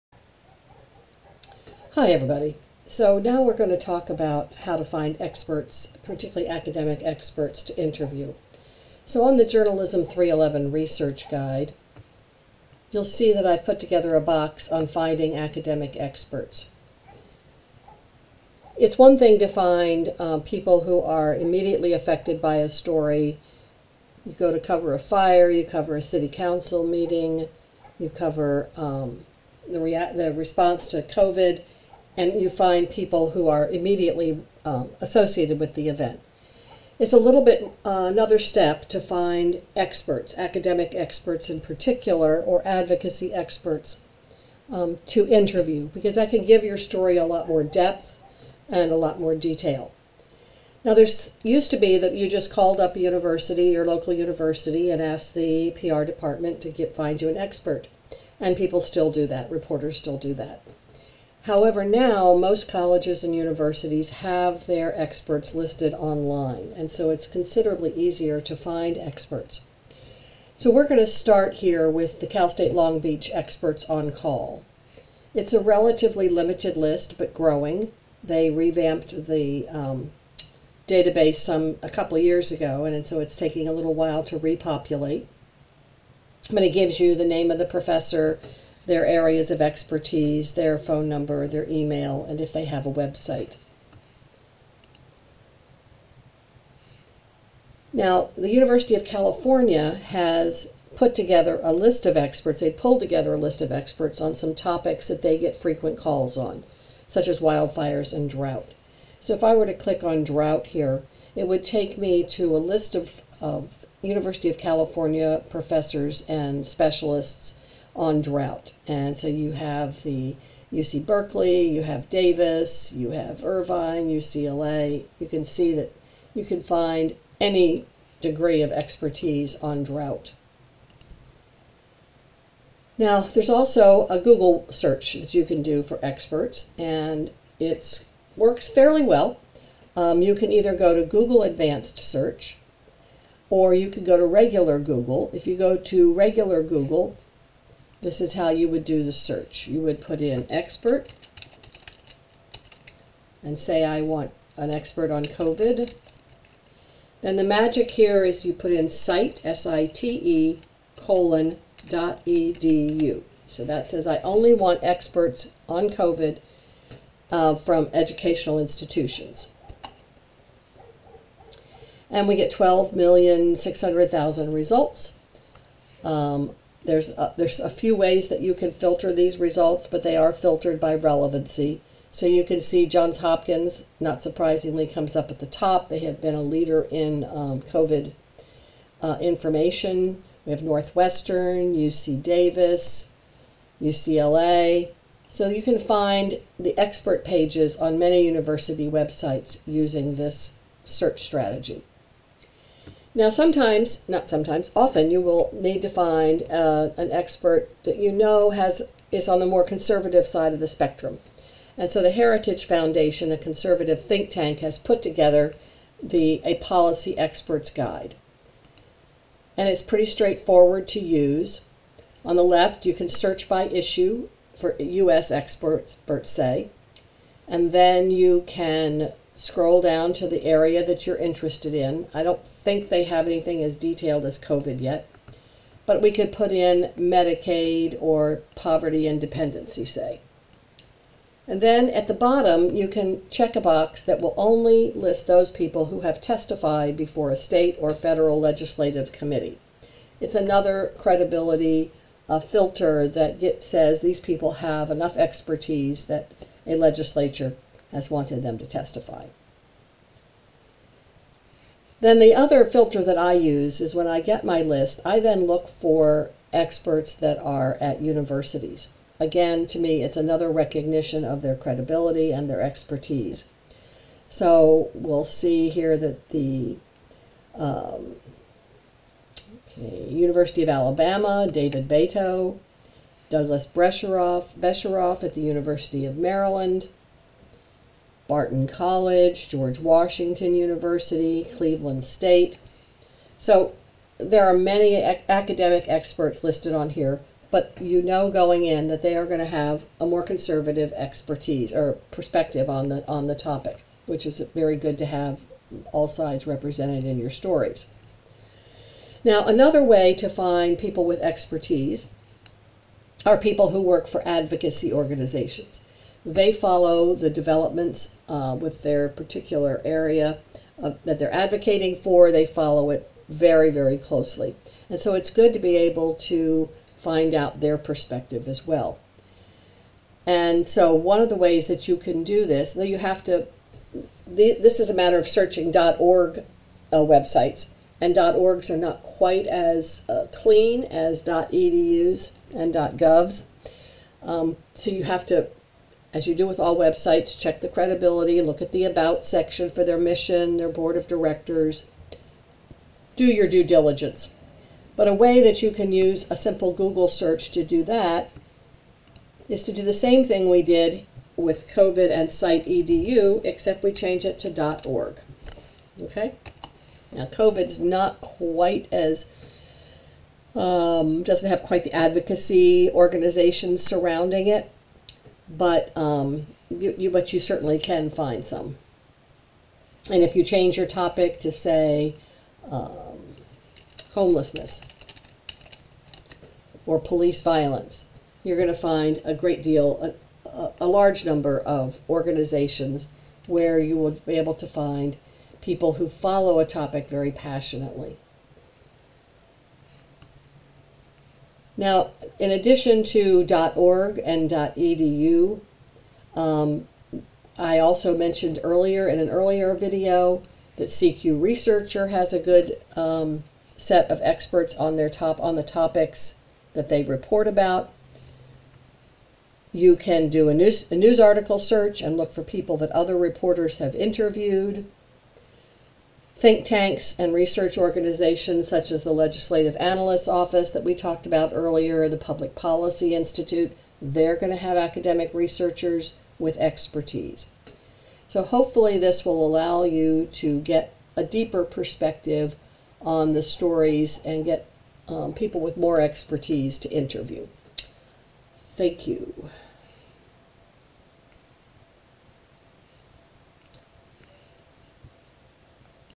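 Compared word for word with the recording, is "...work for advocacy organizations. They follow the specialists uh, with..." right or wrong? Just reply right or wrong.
wrong.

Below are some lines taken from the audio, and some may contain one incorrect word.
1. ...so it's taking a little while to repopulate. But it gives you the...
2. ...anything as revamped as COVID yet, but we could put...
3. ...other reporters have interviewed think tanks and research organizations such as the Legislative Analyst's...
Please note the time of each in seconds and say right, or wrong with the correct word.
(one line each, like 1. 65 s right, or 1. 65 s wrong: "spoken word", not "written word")
1. 83 s right
2. 233 s wrong: "detailed", not "revamped"
3. 422 s right.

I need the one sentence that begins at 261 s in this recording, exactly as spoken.
Then the other filter that I use is when I get my list, I then look for experts that are at universities.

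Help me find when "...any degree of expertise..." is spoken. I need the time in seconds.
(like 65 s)
127 s.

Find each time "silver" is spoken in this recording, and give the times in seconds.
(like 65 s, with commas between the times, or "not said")
not said.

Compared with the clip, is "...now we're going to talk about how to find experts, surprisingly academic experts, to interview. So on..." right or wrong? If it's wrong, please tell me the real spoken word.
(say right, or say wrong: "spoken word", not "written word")
wrong: "particularly", not "surprisingly".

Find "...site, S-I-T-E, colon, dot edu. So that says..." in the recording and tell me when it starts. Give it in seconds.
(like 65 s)
158 s.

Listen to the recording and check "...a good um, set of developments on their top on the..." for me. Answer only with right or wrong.
wrong.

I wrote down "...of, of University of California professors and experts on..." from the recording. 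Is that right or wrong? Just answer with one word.
wrong.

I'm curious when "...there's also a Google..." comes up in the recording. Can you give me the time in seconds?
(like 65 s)
133 s.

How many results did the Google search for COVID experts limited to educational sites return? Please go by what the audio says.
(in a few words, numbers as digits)
12,600,000.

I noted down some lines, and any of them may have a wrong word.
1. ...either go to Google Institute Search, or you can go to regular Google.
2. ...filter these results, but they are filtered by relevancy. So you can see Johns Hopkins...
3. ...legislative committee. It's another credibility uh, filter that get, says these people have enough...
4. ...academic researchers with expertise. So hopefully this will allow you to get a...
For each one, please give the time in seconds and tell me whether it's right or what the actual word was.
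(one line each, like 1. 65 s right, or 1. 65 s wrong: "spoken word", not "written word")
1. 140 s wrong: "Advanced", not "Institute"
2. 178 s right
3. 248 s right
4. 434 s right.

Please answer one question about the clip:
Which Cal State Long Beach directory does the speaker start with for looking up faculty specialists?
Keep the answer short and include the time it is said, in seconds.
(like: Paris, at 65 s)
Experts on Call, at 73 s.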